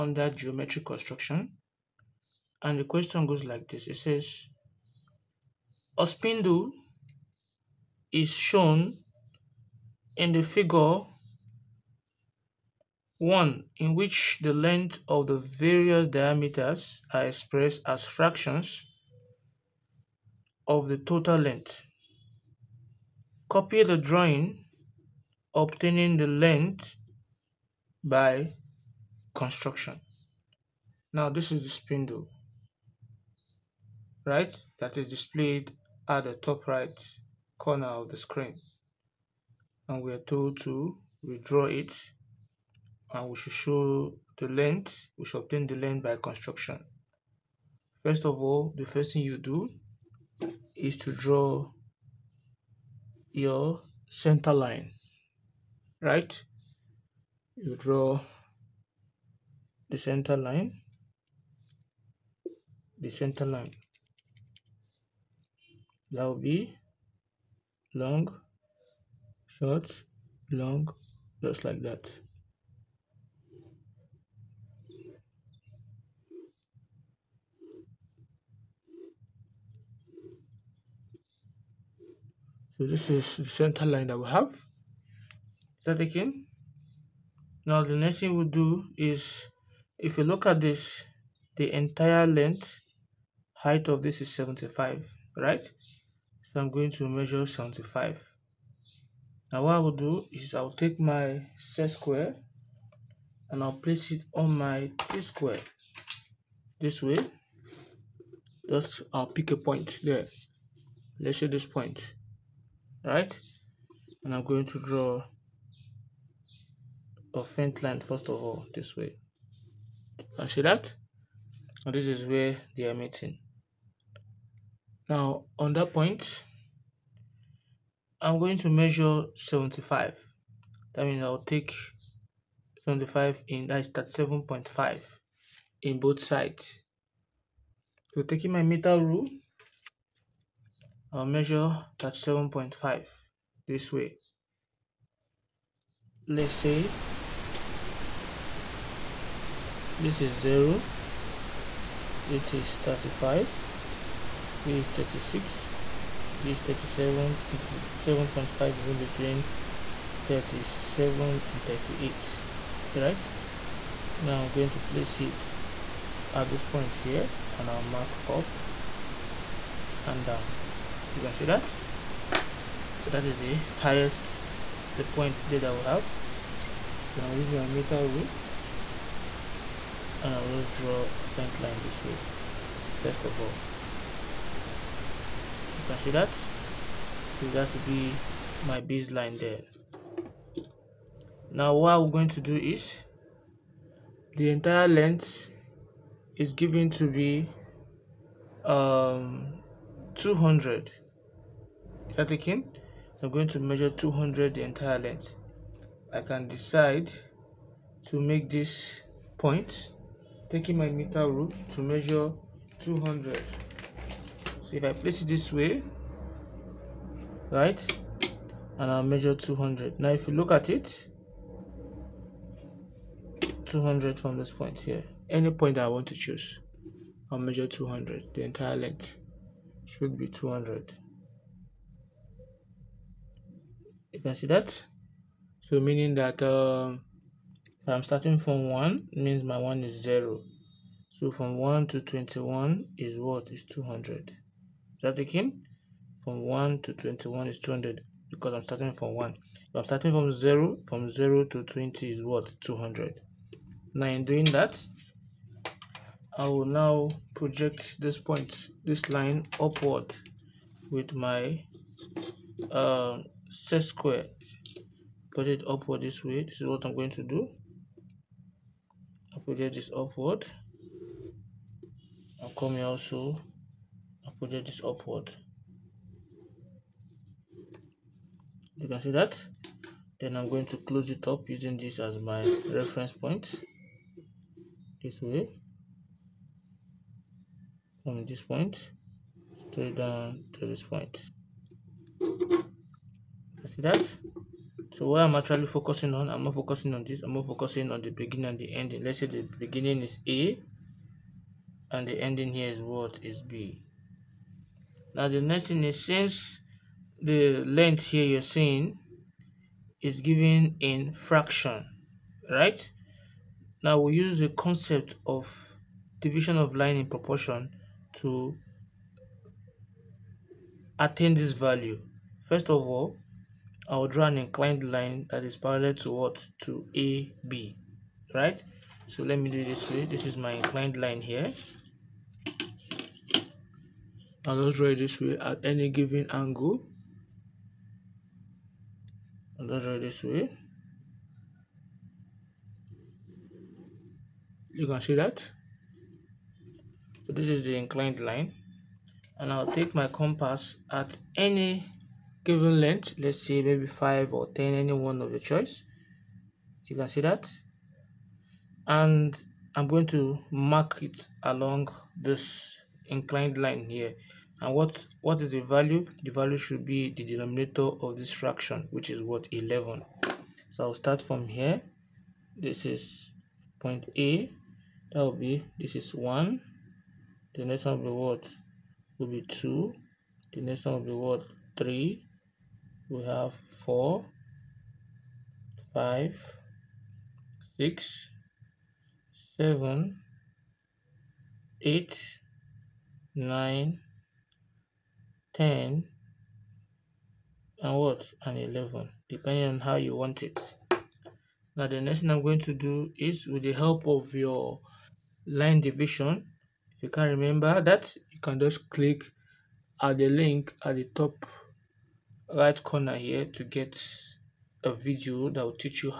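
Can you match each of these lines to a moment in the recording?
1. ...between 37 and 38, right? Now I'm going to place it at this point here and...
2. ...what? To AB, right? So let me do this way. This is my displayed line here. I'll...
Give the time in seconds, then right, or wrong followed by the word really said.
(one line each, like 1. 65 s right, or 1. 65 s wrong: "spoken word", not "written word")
1. 158 s right
2. 326 s wrong: "inclined", not "displayed".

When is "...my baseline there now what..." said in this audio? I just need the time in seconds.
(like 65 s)
188 s.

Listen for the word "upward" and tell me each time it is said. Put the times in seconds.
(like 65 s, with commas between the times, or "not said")
259 s, 265 s, 269 s, 274 s.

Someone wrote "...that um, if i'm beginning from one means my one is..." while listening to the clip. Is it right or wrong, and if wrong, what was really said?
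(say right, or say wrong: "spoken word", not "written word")
wrong: "starting", not "beginning".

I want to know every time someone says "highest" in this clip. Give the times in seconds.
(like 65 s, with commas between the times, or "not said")
173 s.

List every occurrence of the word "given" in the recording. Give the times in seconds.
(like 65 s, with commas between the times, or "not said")
196 s, 310 s, 335 s, 352 s.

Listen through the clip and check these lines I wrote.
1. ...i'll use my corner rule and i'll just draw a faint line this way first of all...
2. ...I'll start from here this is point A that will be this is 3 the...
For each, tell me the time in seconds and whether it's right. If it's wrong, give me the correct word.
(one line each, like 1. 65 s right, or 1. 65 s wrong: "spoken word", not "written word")
1. 177 s wrong: "meter", not "corner"
2. 370 s wrong: "1", not "3".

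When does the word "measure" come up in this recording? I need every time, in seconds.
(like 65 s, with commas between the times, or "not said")
97 s, 128 s, 141 s, 203 s, 211 s, 219 s, 227 s.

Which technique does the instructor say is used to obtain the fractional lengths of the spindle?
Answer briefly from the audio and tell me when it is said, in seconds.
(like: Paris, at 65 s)
division of line in proportion, at 316 s.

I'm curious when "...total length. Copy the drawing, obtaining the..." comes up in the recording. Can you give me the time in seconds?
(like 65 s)
20 s.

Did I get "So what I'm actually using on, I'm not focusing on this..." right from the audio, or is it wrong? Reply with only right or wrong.
wrong.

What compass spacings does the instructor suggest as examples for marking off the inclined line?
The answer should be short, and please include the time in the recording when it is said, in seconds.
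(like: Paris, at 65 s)
5 or 10, at 353 s.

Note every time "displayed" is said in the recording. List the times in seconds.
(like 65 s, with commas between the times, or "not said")
35 s.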